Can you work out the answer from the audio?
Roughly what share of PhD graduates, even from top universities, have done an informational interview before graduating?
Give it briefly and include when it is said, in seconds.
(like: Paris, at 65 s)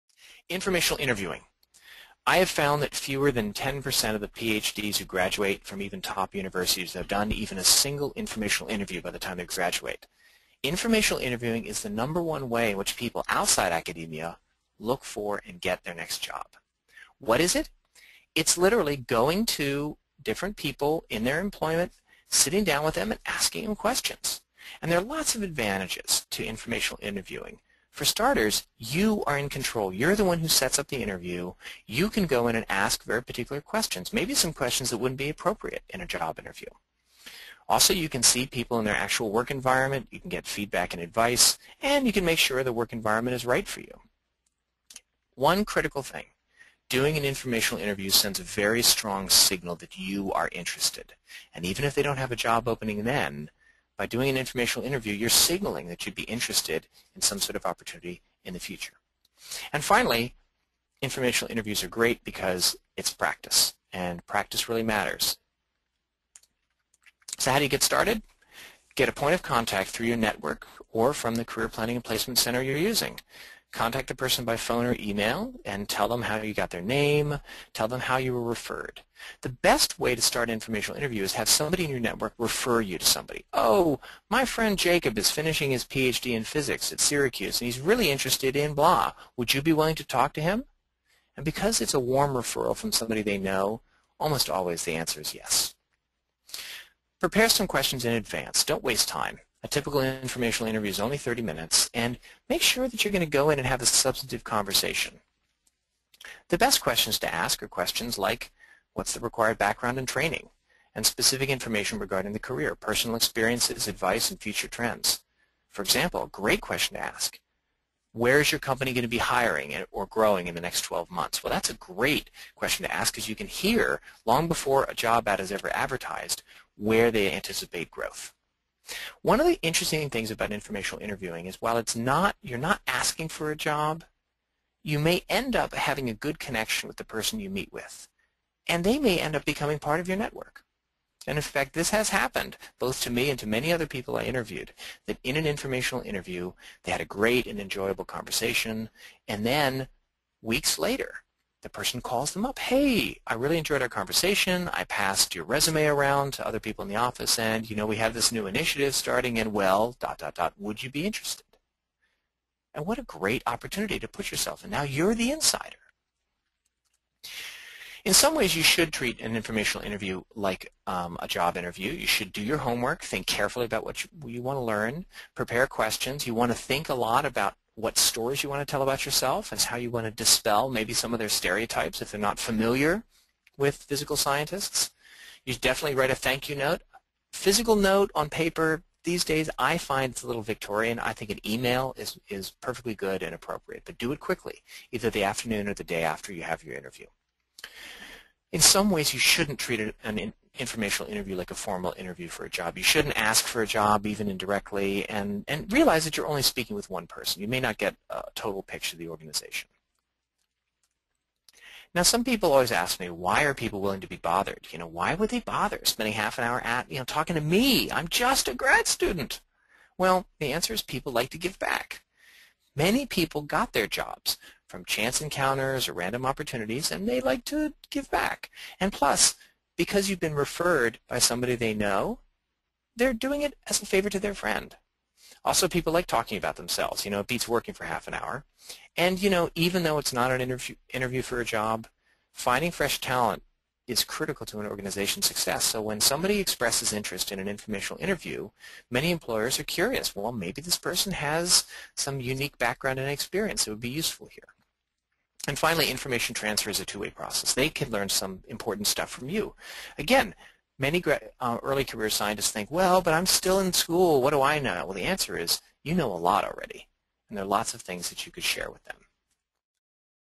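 fewer than 10%, at 2 s.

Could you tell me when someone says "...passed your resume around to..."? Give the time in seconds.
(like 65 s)
154 s.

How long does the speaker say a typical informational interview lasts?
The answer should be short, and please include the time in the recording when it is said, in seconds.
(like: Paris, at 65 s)
30 minutes, at 101 s.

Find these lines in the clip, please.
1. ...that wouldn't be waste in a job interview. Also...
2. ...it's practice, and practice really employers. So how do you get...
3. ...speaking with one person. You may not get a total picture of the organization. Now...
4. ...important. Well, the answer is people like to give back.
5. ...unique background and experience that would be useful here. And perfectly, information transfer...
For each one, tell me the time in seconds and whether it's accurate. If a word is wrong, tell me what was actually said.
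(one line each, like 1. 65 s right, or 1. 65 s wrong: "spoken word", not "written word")
1. 34 s wrong: "appropriate", not "waste"
2. 62 s wrong: "matters", not "employers"
3. 206 s right
4. 218 s wrong: "student", not "important"
5. 252 s wrong: "finally", not "perfectly".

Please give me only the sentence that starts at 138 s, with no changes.
And they may end up becoming part of your network.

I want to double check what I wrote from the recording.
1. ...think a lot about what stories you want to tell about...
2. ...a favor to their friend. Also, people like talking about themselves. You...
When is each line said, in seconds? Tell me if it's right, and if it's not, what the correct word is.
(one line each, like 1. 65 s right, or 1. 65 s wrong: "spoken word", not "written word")
1. 176 s right
2. 233 s right.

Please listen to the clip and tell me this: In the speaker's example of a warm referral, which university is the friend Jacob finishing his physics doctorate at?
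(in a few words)
Syracuse.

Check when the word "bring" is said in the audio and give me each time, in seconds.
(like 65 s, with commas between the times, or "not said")
not said.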